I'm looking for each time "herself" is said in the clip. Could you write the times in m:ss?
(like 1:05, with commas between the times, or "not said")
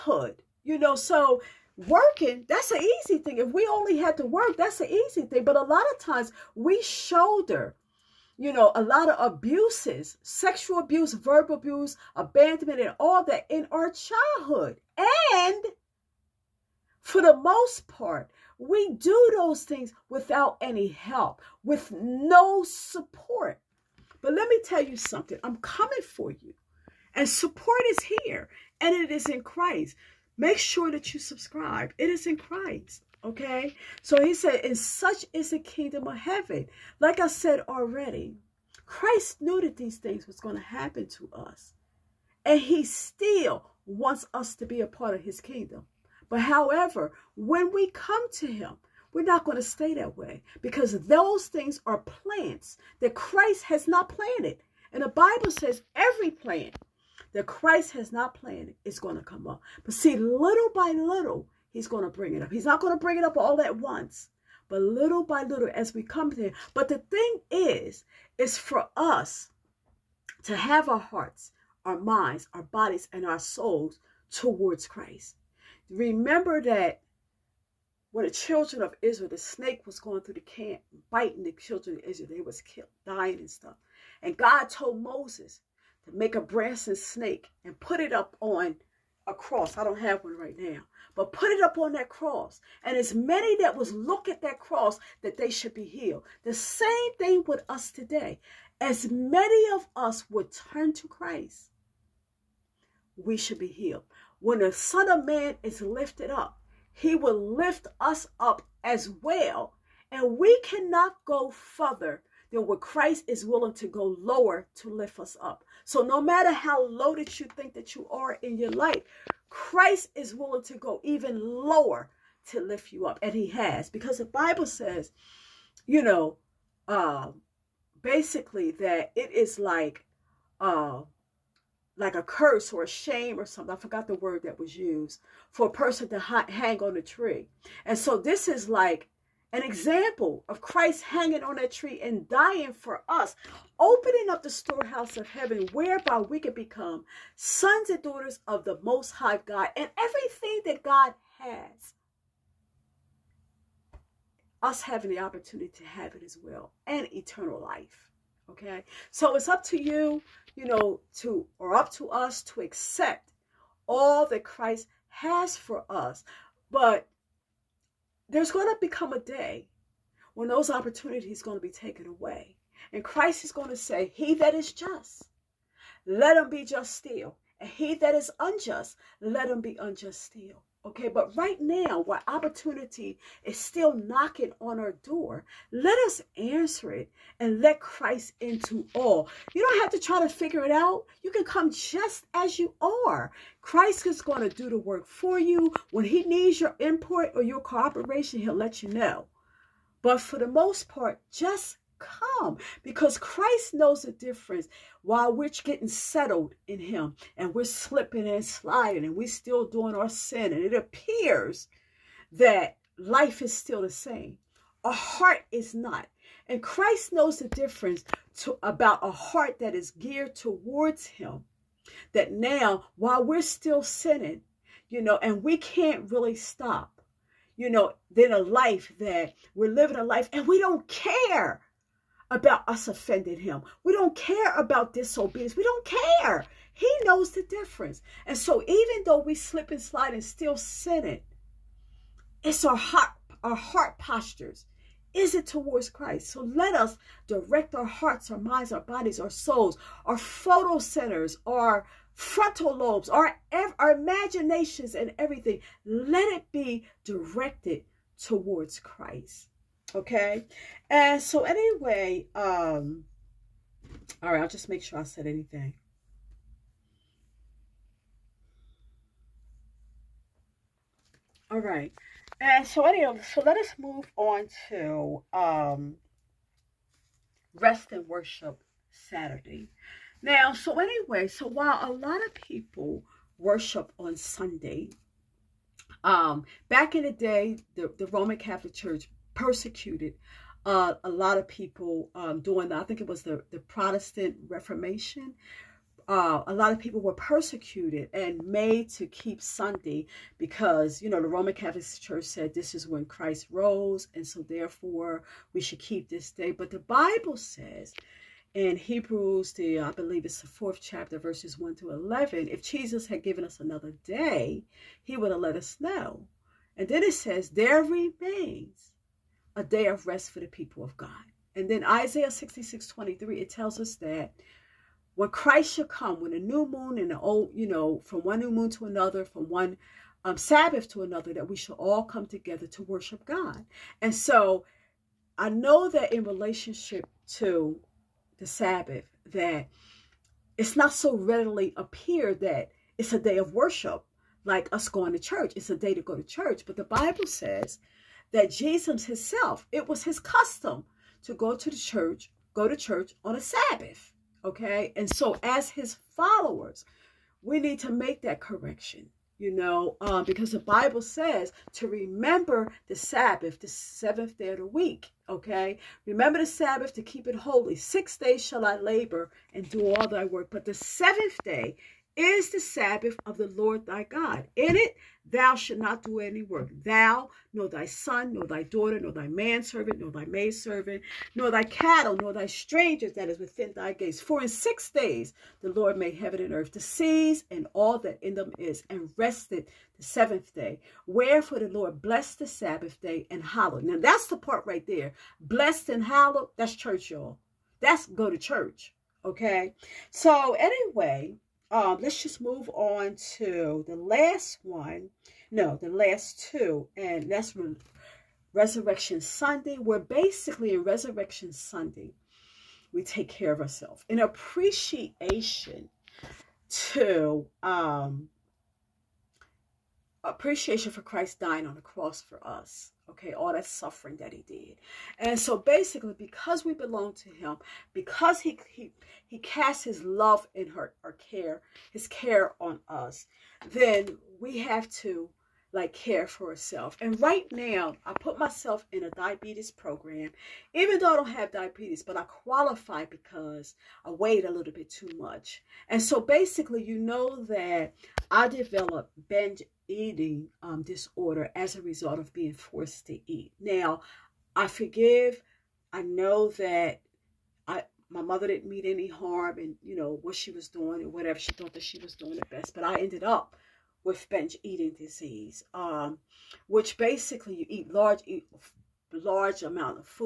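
7:16.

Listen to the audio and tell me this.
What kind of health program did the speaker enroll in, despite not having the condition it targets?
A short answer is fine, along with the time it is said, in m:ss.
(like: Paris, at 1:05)
diabetes program, at 7:19.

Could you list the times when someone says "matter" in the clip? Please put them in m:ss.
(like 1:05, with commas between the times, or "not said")
1:56.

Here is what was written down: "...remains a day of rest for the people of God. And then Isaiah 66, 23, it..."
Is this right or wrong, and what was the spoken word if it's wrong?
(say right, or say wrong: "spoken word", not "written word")
right.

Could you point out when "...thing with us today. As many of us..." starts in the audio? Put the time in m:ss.
1:37.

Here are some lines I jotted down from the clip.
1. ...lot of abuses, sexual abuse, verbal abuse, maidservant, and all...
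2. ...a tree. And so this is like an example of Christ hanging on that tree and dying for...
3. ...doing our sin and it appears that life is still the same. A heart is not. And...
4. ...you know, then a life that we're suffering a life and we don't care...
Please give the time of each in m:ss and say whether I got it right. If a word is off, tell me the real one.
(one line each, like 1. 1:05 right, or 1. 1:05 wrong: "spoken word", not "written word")
1. 0:08 wrong: "abandonment", not "maidservant"
2. 2:16 right
3. 3:29 right
4. 3:47 wrong: "living", not "suffering".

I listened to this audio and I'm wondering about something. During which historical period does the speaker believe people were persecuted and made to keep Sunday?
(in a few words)
Protestant Reformation.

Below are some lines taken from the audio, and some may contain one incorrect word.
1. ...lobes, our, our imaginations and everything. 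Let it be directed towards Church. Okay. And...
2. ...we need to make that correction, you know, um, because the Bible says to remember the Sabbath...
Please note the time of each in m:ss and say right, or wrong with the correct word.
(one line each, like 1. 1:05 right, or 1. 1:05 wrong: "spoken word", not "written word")
1. 4:12 wrong: "Christ", not "Church"
2. 5:57 right.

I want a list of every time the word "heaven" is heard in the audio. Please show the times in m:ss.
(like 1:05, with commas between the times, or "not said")
0:36, 2:25, 6:26.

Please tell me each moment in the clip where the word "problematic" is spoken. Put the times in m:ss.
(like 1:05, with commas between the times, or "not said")
not said.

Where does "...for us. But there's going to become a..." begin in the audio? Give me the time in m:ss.
2:45.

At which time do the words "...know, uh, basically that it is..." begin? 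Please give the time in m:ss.
2:06.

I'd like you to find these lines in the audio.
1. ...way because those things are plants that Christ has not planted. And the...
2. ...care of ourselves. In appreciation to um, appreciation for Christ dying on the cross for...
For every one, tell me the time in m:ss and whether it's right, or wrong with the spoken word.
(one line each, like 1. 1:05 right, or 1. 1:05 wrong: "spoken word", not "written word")
1. 0:50 right
2. 6:53 right.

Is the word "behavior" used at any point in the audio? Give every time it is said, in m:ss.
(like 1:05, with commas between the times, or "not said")
not said.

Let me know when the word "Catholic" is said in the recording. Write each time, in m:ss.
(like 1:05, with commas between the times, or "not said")
4:48, 5:01.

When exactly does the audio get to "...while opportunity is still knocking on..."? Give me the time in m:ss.
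3:01.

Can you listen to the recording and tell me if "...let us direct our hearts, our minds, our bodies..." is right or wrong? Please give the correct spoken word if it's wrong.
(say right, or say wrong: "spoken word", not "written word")
right.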